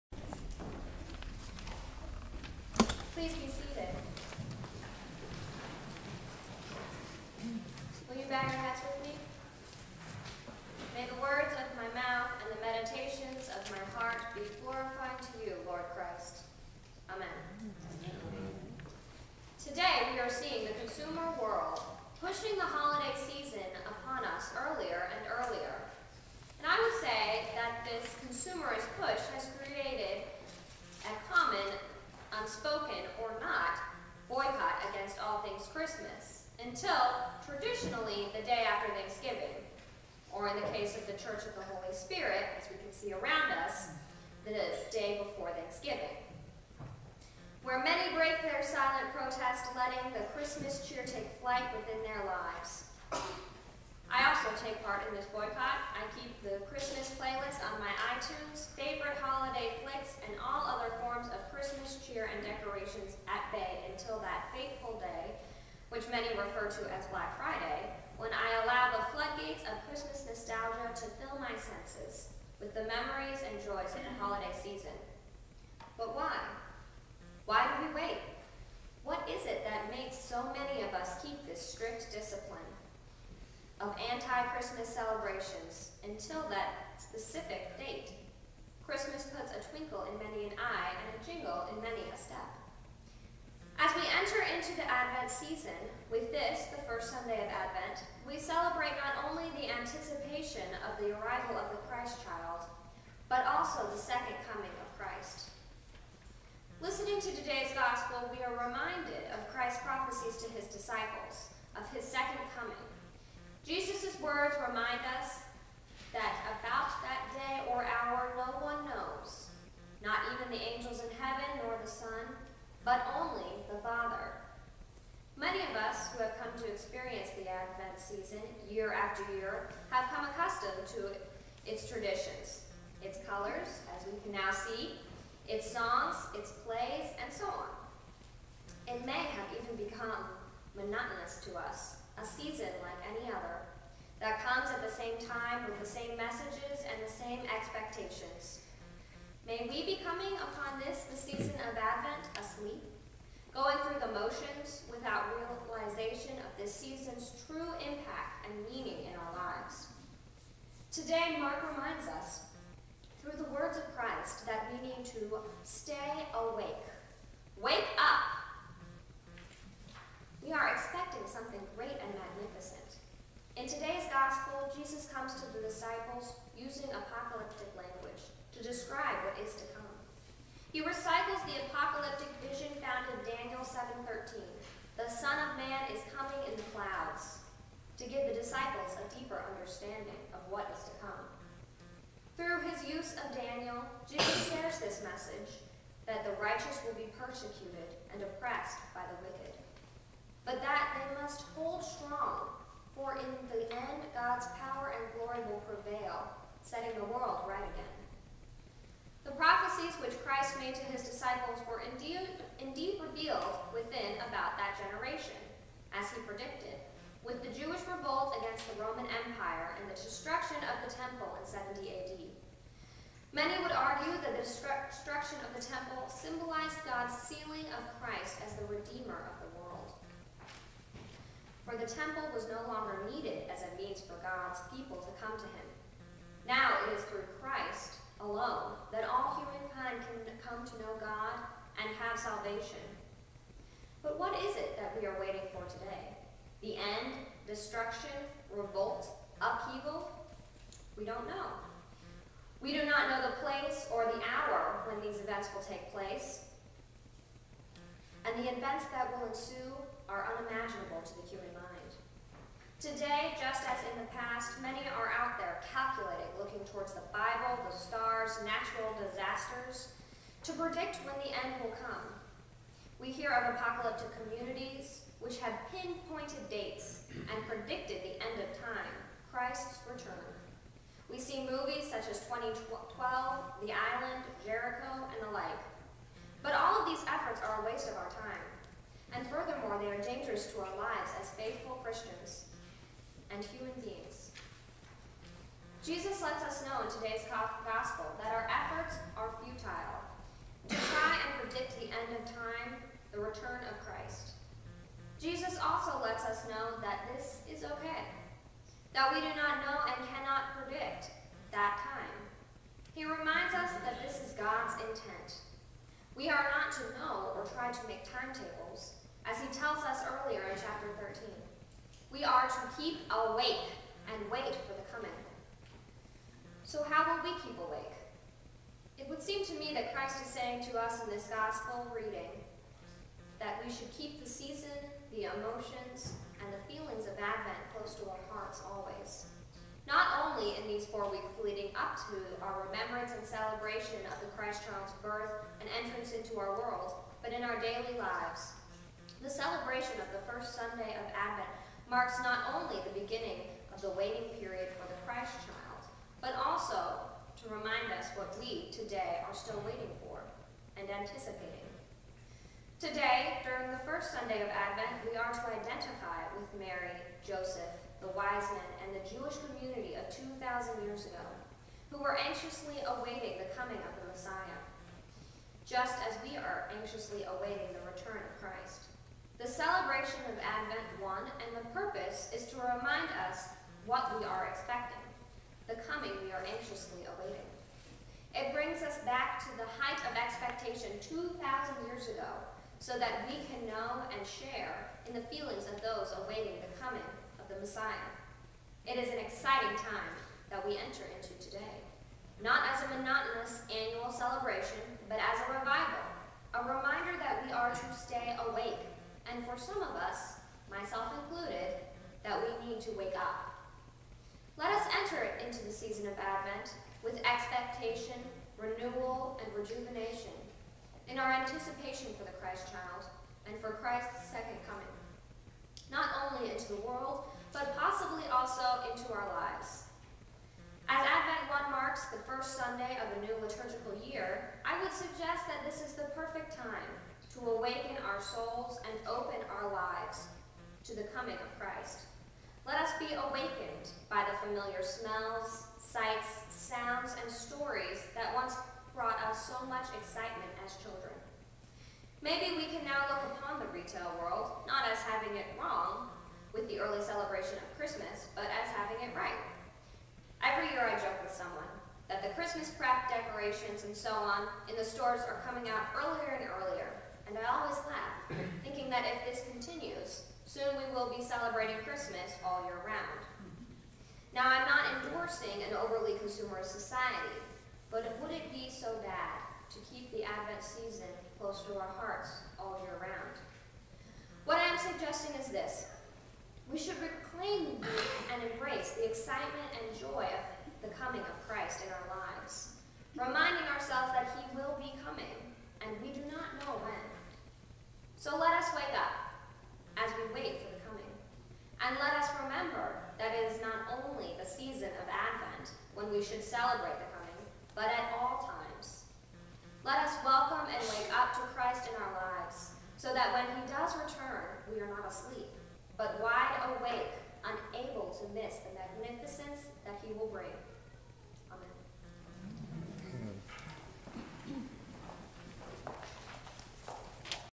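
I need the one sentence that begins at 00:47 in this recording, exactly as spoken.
Where many break their silent protest letting the Christmas cheer take flight within their lives.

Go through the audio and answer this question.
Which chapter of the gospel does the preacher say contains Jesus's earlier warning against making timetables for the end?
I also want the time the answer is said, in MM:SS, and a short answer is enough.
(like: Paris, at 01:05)
chapter 13, at 05:20.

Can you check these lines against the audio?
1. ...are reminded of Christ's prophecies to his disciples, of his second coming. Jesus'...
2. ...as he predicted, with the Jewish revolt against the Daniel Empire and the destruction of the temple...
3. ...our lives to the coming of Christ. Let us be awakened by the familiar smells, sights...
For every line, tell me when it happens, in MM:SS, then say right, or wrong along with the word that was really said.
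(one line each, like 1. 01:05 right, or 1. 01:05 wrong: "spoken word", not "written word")
1. 01:48 right
2. 03:35 wrong: "Roman", not "Daniel"
3. 07:19 right.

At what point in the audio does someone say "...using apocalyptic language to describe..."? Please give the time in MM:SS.
02:56.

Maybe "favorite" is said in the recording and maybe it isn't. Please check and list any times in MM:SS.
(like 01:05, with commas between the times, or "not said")
00:58.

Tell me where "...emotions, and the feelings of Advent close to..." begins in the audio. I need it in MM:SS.
05:35.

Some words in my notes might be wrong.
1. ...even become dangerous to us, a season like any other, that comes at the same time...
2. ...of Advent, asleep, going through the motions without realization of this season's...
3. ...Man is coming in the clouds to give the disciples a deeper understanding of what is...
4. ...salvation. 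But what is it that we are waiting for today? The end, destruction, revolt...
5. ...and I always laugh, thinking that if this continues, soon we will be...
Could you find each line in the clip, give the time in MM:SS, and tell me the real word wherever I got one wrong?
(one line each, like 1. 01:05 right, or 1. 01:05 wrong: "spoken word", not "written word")
1. 02:19 wrong: "monotonous", not "dangerous"
2. 02:31 right
3. 03:05 right
4. 04:02 right
5. 07:47 right.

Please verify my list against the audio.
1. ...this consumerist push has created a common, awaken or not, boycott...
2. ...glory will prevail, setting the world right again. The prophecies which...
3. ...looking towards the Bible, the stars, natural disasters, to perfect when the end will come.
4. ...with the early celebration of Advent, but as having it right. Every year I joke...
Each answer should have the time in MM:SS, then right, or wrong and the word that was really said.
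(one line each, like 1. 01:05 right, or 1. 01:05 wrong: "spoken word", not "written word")
1. 00:27 wrong: "unspoken", not "awaken"
2. 03:25 right
3. 04:26 wrong: "predict", not "perfect"
4. 07:36 wrong: "Christmas", not "Advent".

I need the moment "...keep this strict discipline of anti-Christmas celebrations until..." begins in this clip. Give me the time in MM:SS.
01:21.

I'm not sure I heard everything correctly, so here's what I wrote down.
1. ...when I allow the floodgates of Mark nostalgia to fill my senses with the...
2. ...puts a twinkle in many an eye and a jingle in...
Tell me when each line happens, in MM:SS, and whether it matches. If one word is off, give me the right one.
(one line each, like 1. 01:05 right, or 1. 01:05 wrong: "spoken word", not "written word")
1. 01:08 wrong: "Christmas", not "Mark"
2. 01:29 right.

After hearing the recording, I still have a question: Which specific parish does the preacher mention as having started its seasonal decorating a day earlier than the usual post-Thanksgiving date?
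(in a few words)
Church of the Holy Spirit.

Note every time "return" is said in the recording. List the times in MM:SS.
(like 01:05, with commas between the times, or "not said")
04:39, 05:03, 06:17, 08:33.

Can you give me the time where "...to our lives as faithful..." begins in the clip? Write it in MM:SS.
04:50.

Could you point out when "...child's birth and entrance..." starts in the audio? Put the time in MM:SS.
05:44.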